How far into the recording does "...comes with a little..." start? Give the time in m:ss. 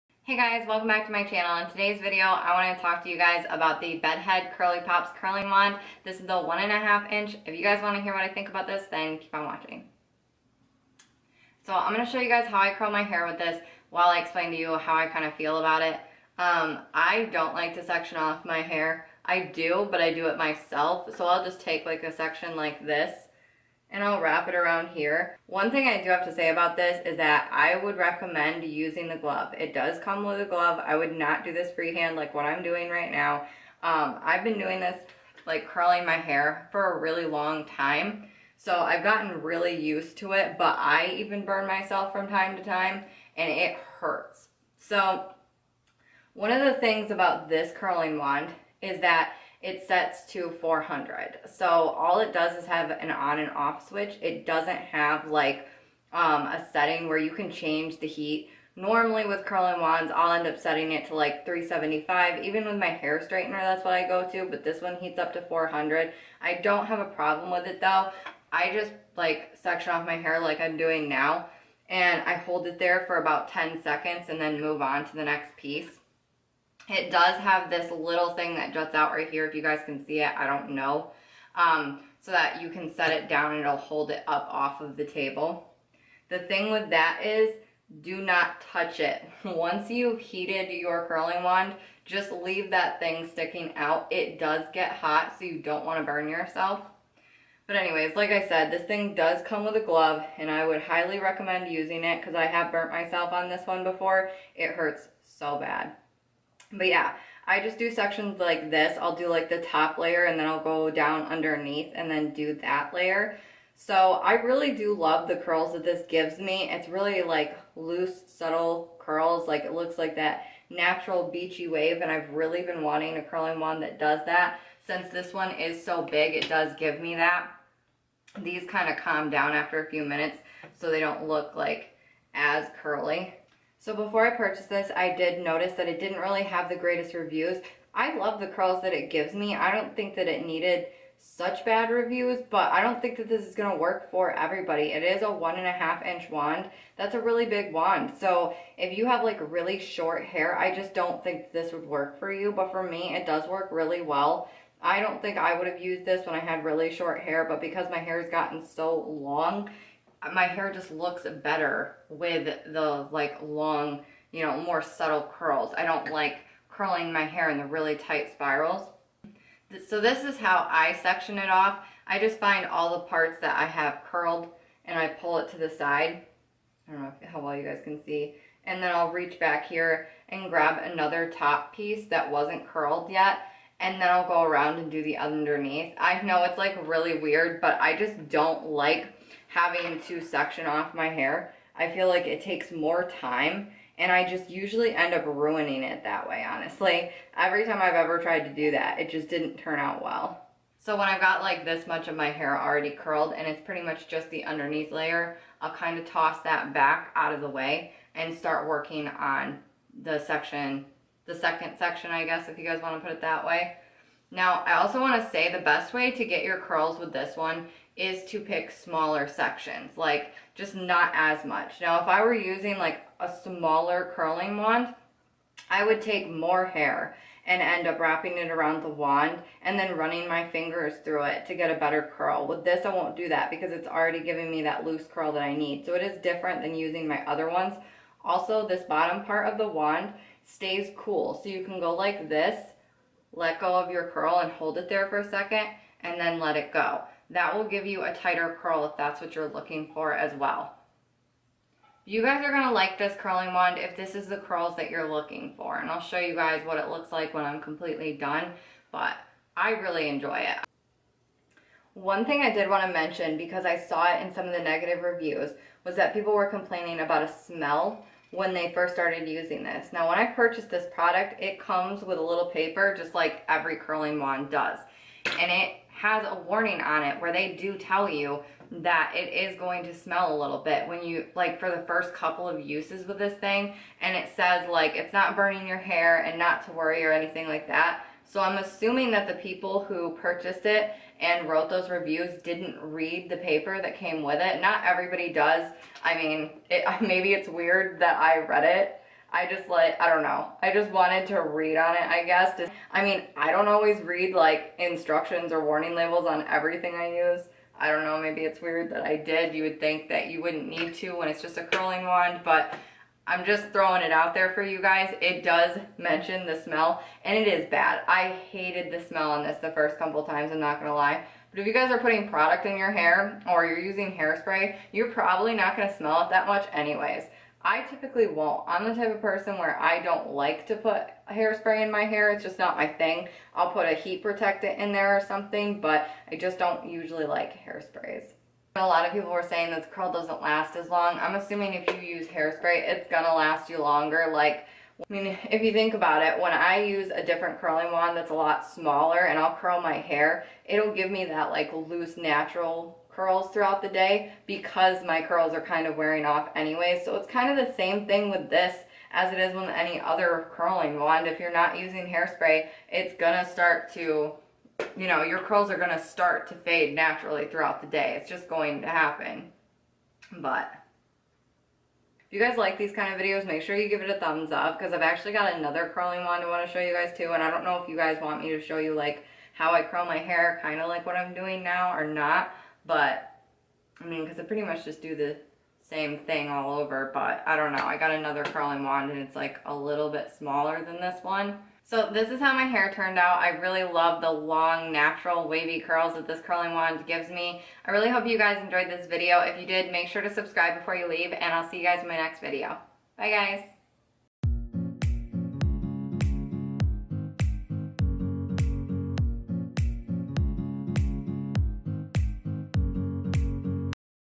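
4:31.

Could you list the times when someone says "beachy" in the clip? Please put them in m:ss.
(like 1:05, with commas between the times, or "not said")
2:01.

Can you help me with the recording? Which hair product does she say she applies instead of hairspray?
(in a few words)
heat protectant.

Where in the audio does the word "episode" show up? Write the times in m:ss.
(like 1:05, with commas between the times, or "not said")
not said.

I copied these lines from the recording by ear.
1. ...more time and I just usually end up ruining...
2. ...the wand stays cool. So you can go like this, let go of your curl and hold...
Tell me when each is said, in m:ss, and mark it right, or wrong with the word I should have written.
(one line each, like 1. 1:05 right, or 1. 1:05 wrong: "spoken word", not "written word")
1. 3:12 right
2. 3:59 right.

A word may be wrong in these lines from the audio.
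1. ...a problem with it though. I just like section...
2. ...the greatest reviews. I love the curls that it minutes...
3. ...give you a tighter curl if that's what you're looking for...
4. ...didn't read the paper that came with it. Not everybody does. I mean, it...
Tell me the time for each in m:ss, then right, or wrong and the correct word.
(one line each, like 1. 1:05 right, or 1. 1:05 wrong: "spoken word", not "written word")
1. 1:06 right
2. 2:16 wrong: "gives", not "minutes"
3. 4:07 right
4. 4:52 right.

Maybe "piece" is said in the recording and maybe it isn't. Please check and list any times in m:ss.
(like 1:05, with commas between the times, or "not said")
1:15, 3:01.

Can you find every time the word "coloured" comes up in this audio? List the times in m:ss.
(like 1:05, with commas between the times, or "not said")
not said.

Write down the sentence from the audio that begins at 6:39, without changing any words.
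If you did, make sure to subscribe before you leave, and I'll see you guys in my next video.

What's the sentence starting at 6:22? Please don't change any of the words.
But I mean, because I pretty much just do the same thing all over.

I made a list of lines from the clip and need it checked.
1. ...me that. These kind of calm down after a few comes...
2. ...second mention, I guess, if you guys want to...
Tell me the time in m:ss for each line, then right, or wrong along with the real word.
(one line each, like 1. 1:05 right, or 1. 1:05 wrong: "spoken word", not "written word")
1. 2:07 wrong: "minutes", not "comes"
2. 3:31 wrong: "section", not "mention".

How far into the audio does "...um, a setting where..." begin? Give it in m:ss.
0:56.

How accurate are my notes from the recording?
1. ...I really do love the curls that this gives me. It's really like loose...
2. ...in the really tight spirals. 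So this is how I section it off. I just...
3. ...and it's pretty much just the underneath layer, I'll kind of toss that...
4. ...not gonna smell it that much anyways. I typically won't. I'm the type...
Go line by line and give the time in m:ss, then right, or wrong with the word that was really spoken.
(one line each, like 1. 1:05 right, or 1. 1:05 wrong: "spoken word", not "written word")
1. 1:54 right
2. 2:47 right
3. 3:23 right
4. 5:25 right.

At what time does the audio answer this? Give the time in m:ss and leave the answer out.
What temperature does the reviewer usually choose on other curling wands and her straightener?
1:01.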